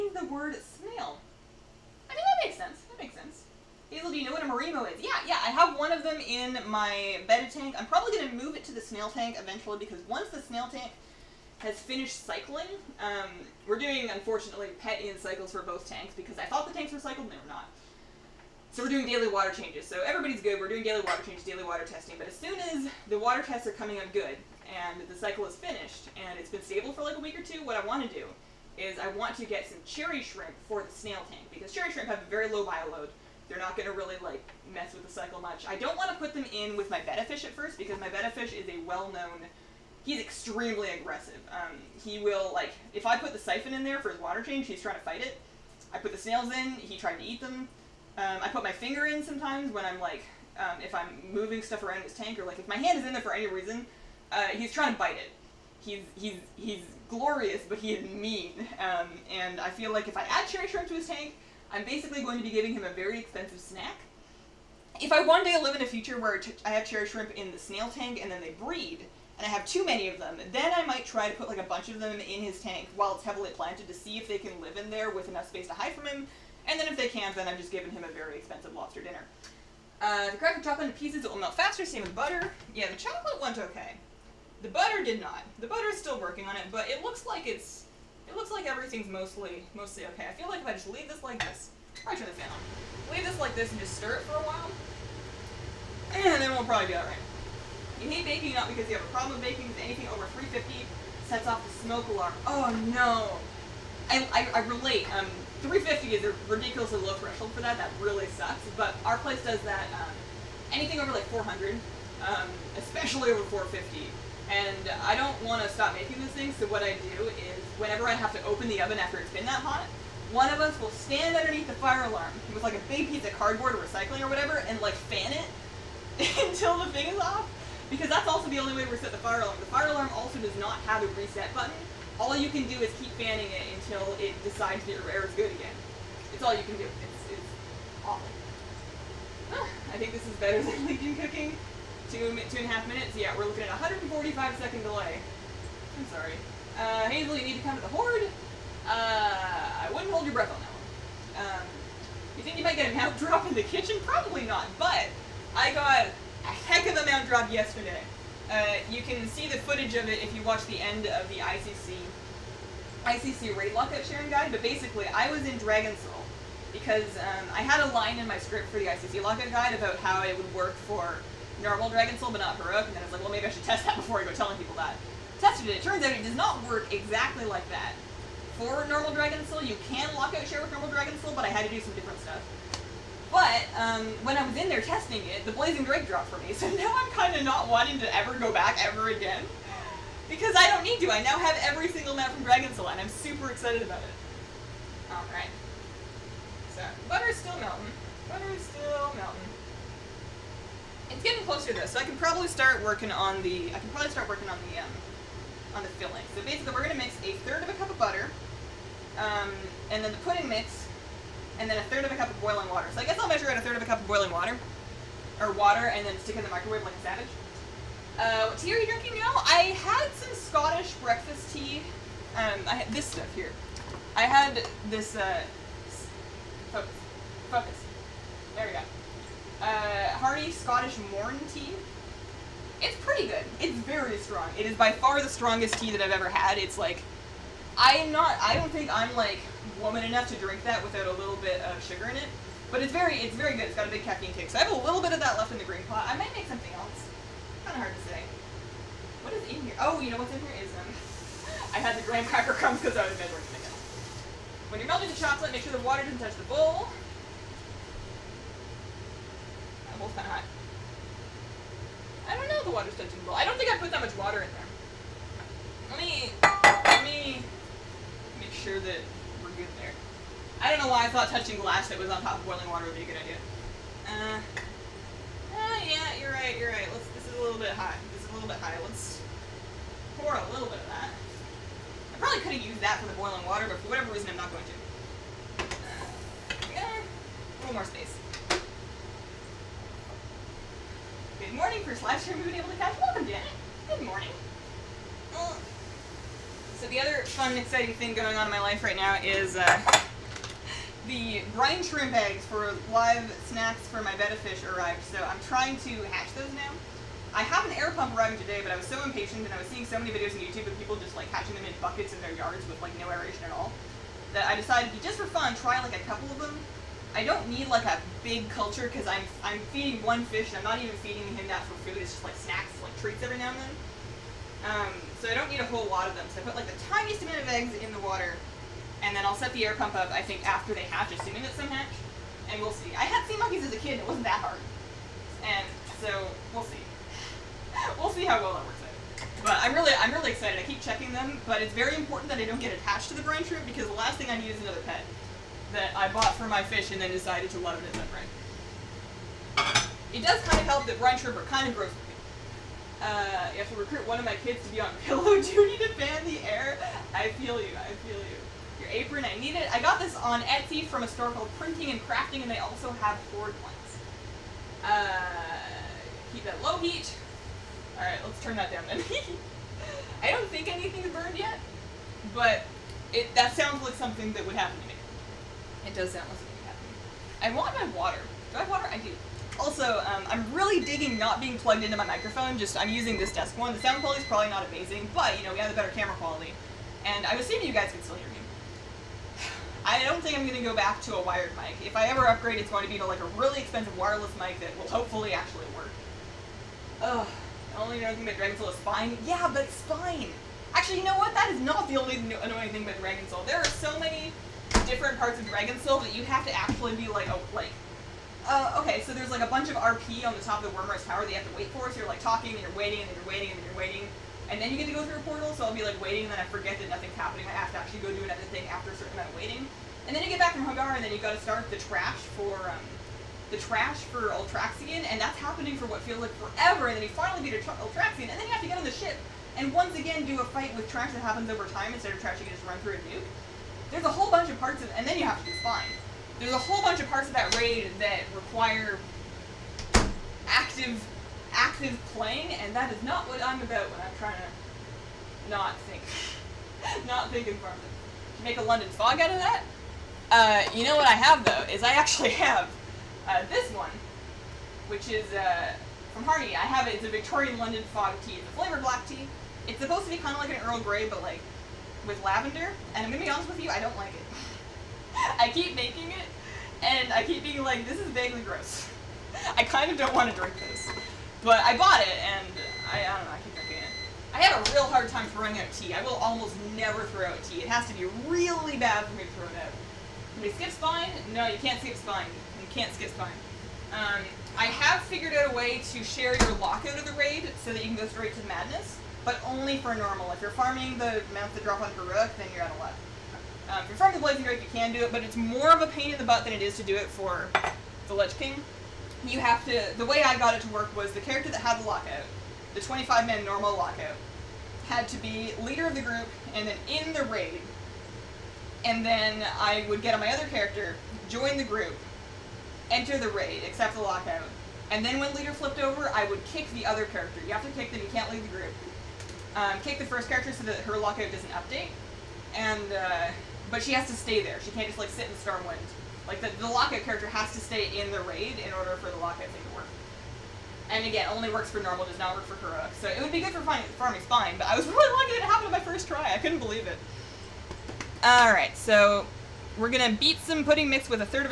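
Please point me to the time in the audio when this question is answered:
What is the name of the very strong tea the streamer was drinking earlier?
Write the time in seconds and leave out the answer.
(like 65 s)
230 s.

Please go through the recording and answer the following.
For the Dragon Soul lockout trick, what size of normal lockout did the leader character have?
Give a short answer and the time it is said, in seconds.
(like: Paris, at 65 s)
25-man, at 502 s.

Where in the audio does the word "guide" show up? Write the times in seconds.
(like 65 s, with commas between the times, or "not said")
164 s, 169 s.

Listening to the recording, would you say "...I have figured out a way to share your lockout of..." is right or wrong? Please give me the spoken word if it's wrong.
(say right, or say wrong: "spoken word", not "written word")
right.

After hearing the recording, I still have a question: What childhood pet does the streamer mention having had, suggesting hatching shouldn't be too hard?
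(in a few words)
sea monkeys.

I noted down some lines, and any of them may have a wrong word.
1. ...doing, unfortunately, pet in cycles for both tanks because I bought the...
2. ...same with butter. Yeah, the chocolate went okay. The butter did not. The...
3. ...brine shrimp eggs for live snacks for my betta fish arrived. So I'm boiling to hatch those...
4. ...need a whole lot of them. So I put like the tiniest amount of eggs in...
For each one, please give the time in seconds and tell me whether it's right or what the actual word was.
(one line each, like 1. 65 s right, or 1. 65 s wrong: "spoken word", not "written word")
1. 13 s wrong: "thought", not "bought"
2. 81 s right
3. 301 s wrong: "trying", not "boiling"
4. 325 s right.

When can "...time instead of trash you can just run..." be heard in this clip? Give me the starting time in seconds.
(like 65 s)
431 s.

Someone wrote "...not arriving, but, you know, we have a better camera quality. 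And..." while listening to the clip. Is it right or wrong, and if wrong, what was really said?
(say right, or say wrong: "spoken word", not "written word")
wrong: "amazing", not "arriving".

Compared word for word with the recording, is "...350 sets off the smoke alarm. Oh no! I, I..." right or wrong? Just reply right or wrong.
right.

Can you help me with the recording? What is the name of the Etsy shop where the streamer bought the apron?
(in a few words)
Printing and Crafting.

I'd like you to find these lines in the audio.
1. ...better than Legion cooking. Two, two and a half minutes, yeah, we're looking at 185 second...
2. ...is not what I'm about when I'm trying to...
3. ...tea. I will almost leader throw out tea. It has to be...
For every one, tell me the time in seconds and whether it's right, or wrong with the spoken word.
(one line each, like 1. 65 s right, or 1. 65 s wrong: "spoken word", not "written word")
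1. 140 s wrong: "145", not "185"
2. 442 s right
3. 475 s wrong: "never", not "leader".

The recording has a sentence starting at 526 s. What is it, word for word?
Like the, the lockout character has to stay in the raid in order for the lockout thing to work.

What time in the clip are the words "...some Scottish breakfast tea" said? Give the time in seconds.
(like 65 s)
220 s.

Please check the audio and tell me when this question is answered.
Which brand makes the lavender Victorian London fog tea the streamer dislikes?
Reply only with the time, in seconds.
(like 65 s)
456 s.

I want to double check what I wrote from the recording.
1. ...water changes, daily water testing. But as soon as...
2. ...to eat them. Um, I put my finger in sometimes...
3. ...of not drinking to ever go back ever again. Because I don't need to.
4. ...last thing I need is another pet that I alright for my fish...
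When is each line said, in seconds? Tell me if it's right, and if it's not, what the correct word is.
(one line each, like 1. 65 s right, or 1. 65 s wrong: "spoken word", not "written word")
1. 20 s right
2. 47 s right
3. 187 s wrong: "wanting", not "drinking"
4. 343 s wrong: "bought", not "alright".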